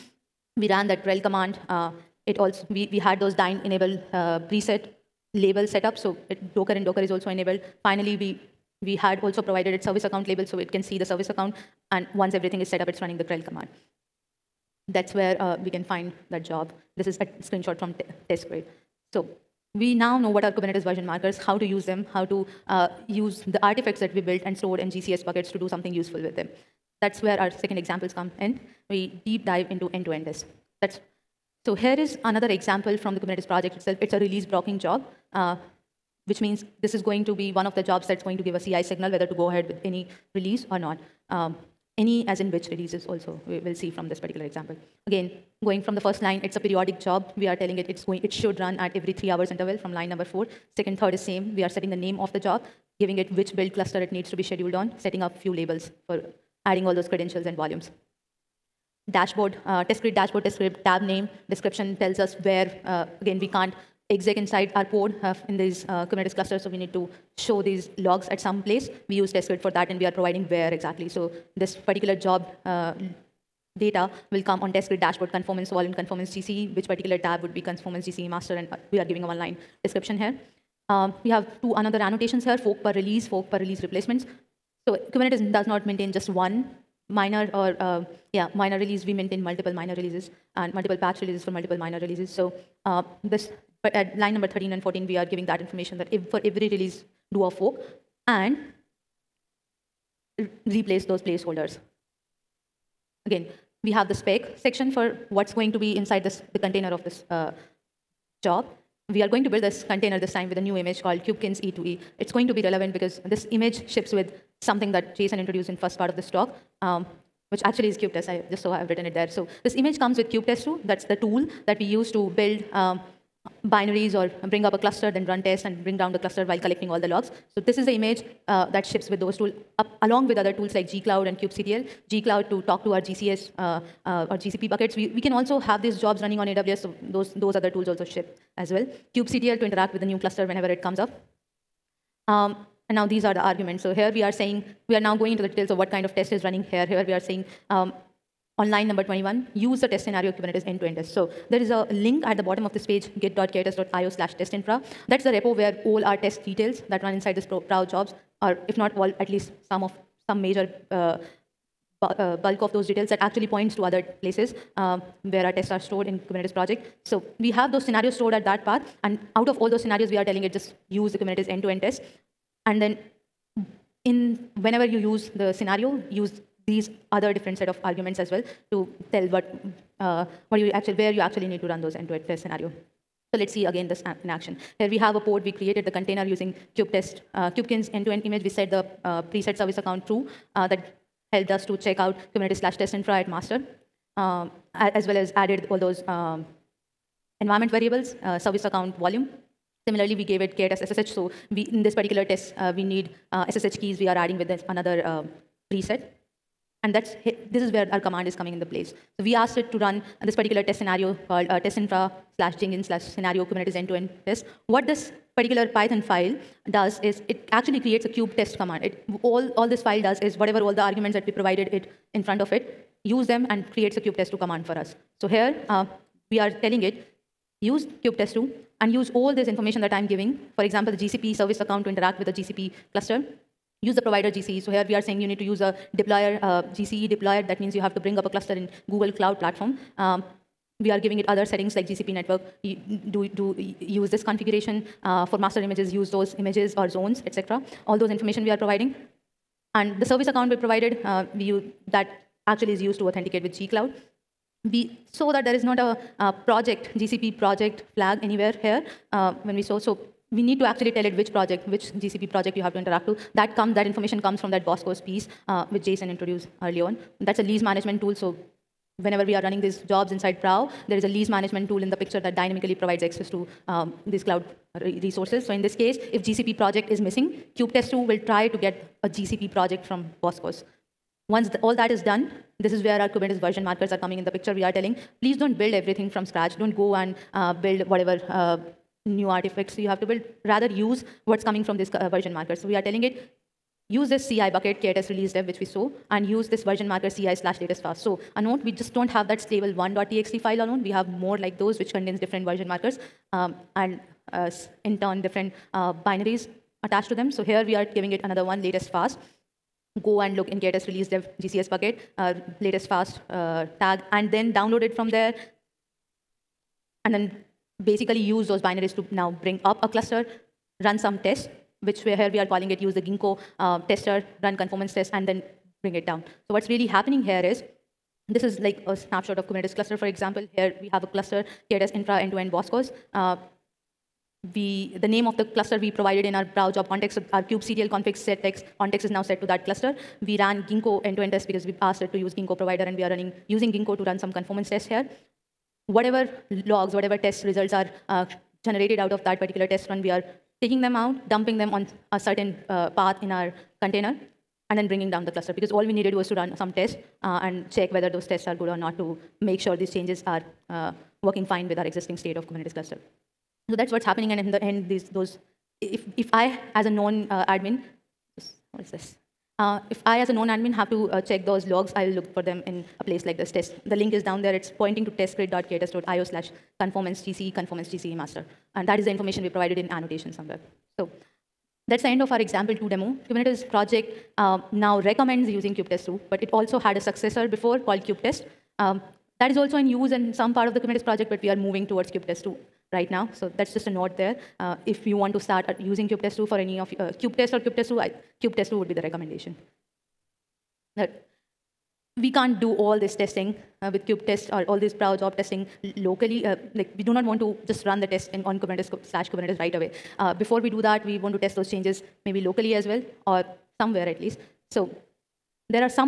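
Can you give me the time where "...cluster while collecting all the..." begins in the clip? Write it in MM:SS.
02:06.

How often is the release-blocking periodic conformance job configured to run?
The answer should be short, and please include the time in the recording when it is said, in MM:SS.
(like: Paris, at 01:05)
Every 3 hours, at 00:48.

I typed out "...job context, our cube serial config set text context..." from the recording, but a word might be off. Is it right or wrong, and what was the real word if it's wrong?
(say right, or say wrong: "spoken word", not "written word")
right.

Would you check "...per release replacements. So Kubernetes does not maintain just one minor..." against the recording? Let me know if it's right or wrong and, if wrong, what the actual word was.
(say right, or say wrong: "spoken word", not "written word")
right.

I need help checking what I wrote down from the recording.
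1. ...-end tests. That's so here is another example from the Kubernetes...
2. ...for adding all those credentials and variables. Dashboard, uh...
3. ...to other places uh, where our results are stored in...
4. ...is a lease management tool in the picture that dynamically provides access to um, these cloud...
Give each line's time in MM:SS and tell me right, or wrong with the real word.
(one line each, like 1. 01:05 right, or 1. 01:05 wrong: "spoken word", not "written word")
1. 00:30 right
2. 00:56 wrong: "volumes", not "variables"
3. 02:43 wrong: "tests", not "results"
4. 04:30 right.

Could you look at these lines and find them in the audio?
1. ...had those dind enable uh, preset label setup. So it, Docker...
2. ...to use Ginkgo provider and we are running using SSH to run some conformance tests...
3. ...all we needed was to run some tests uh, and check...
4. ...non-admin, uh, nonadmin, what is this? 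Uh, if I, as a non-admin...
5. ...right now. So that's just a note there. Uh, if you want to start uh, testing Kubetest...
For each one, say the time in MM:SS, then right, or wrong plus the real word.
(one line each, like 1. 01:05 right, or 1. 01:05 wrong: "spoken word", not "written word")
1. 00:02 right
2. 05:42 wrong: "Ginkgo", not "SSH"
3. 05:55 right
4. 06:06 wrong: "admin", not "nonadmin"
5. 06:32 wrong: "using", not "testing".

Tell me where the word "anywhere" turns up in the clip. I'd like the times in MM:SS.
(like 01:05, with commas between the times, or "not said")
04:18.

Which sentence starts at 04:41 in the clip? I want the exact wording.
Once the, all that is done, this is where our Kubernetes version markers are coming in the picture.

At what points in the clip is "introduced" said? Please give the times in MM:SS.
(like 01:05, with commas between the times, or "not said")
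01:55, 04:26.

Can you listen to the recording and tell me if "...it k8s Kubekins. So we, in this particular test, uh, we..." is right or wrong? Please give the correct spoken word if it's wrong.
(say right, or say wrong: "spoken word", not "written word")
wrong: "SSH", not "Kubekins".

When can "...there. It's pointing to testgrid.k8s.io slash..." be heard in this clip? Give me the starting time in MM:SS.
06:14.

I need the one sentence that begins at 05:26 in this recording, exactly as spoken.
So what's really happening here is, this is like a snapshot of Kubernetes cluster, for example.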